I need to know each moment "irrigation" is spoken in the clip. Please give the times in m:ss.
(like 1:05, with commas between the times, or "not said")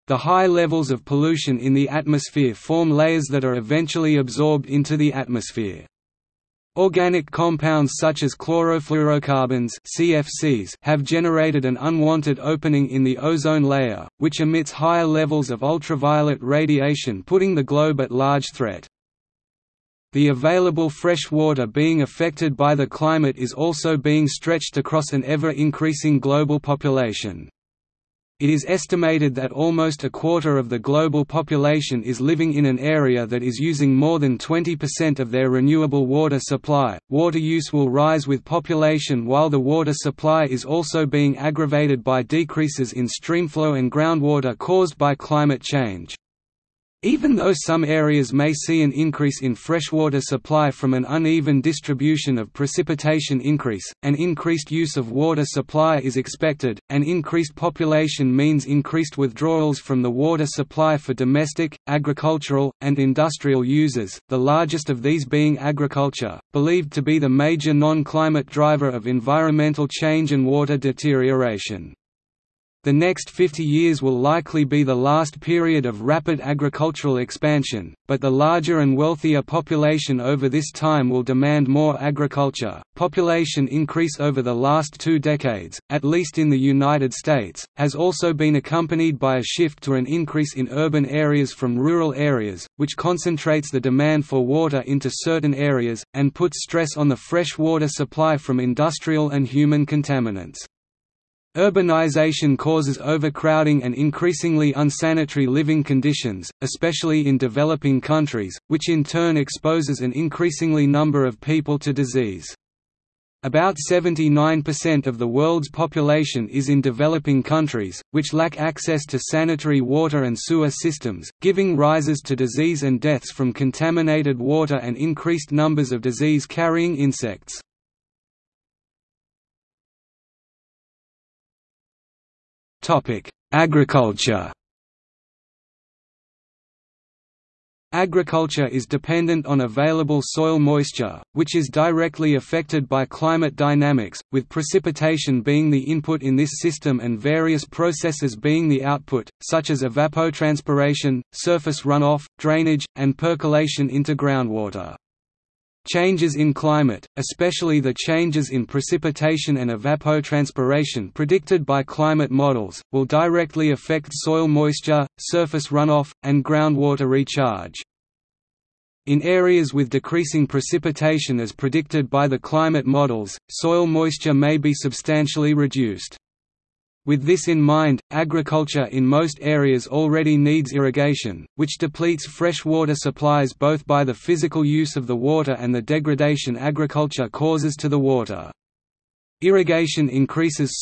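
3:00, 3:09.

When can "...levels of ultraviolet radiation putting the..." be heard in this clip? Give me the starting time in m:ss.
0:15.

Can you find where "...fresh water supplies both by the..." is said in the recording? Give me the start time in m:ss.
3:02.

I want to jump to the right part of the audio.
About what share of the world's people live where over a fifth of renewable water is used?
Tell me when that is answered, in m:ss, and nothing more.
0:30.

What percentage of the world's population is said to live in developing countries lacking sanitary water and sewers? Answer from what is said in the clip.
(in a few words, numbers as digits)
79%.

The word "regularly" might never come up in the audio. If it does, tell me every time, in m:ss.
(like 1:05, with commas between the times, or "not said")
not said.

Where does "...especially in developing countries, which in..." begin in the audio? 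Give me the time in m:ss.
1:46.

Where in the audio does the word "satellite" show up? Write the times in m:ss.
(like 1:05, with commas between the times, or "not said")
not said.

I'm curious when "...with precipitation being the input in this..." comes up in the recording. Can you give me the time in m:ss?
2:24.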